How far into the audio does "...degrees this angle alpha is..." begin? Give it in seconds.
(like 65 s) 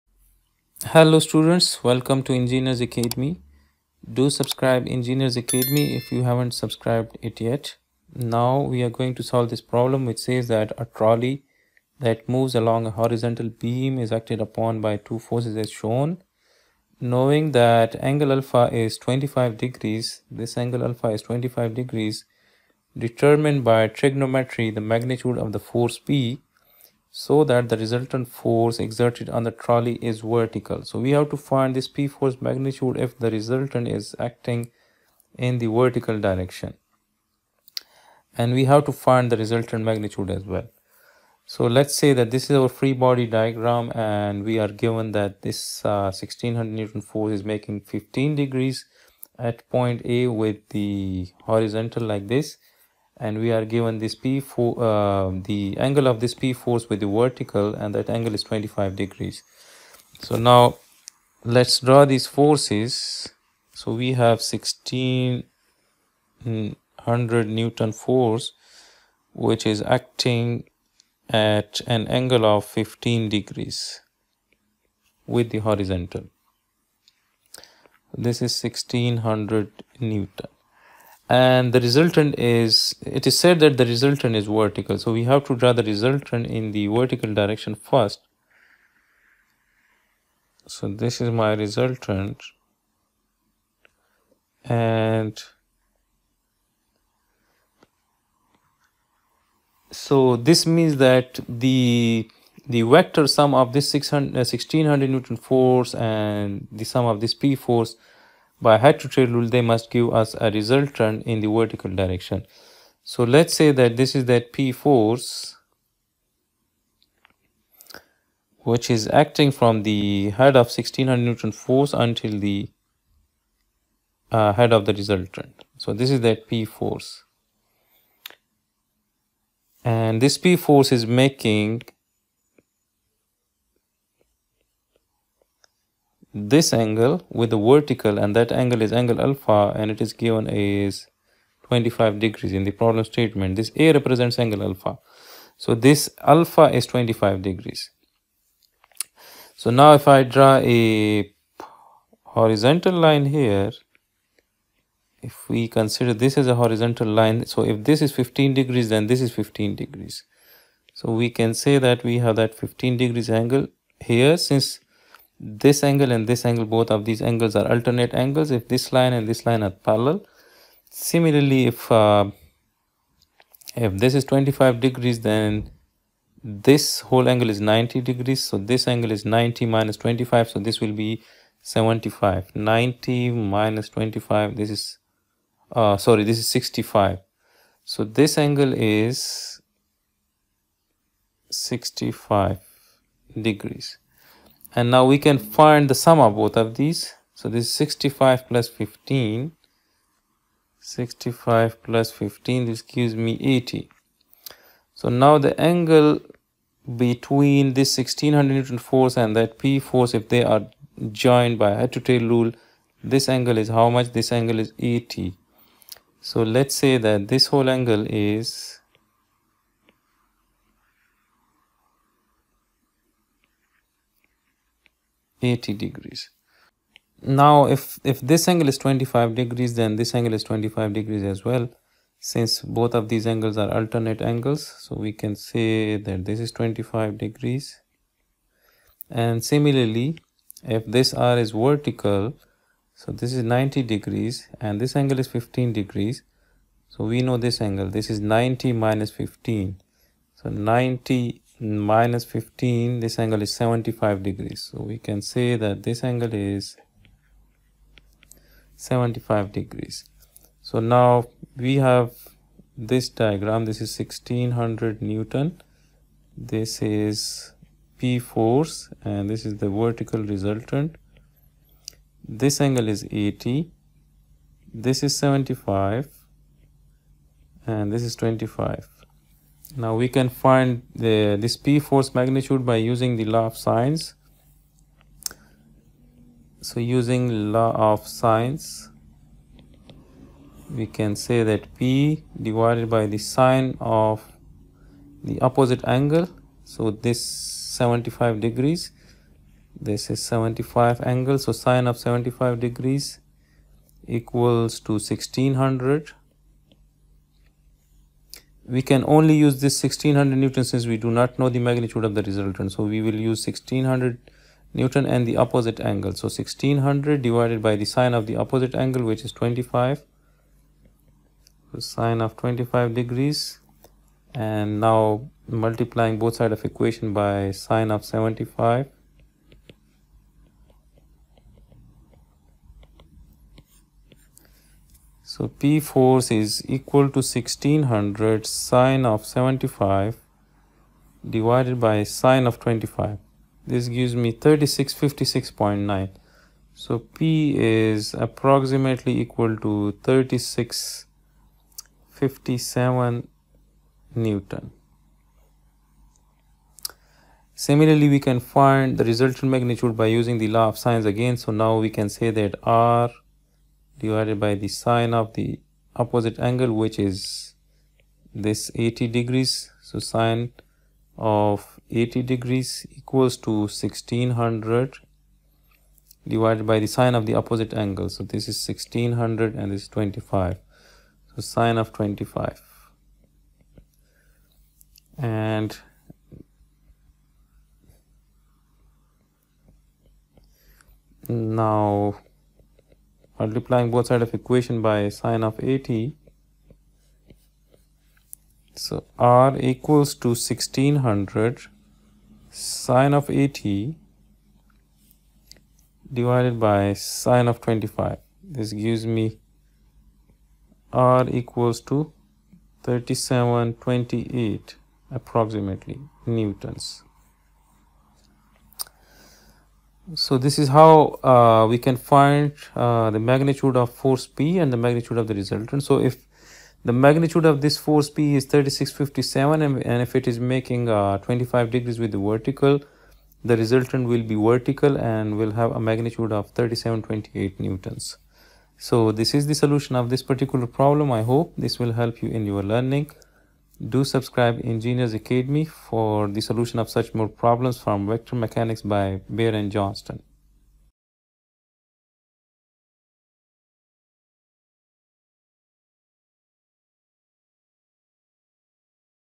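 19 s.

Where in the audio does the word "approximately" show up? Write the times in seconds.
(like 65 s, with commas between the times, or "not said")
348 s, 415 s.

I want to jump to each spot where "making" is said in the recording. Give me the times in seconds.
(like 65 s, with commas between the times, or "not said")
47 s, 131 s, 430 s.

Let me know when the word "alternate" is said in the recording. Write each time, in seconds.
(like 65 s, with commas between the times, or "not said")
167 s, 233 s.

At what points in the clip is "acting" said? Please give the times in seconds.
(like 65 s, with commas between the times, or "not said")
34 s, 69 s, 119 s.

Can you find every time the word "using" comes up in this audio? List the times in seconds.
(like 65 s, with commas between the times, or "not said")
282 s, 286 s, 360 s.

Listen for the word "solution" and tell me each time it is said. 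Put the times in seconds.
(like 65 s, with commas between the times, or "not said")
439 s, 446 s.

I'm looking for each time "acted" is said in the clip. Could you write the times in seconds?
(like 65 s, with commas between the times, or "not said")
14 s.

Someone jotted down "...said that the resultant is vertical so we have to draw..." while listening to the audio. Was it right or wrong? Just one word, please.
right.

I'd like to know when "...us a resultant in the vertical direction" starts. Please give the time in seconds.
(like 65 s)
110 s.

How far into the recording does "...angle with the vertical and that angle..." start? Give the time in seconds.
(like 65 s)
136 s.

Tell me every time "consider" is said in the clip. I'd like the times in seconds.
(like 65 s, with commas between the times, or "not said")
155 s.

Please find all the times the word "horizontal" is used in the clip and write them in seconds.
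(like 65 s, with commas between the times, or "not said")
12 s, 51 s, 75 s, 152 s, 156 s.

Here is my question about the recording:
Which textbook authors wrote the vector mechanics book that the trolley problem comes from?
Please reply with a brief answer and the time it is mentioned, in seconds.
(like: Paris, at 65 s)
Beer and Johnston, at 449 s.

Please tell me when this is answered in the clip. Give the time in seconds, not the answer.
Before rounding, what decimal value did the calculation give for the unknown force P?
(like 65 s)
344 s.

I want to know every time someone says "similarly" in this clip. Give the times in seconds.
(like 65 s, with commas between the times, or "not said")
170 s, 239 s, 357 s.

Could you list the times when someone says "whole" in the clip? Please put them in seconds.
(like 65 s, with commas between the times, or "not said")
176 s, 217 s.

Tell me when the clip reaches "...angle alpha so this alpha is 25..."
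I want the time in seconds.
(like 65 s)
144 s.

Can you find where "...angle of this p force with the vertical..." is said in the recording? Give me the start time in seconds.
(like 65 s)
55 s.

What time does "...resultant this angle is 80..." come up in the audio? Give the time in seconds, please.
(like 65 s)
270 s.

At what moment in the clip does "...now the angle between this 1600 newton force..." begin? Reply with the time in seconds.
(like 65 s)
205 s.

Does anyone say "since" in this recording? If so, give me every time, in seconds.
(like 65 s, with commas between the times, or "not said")
164 s, 232 s, 310 s.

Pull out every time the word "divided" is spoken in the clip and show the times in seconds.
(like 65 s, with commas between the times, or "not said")
292 s, 317 s, 341 s, 364 s, 376 s, 406 s.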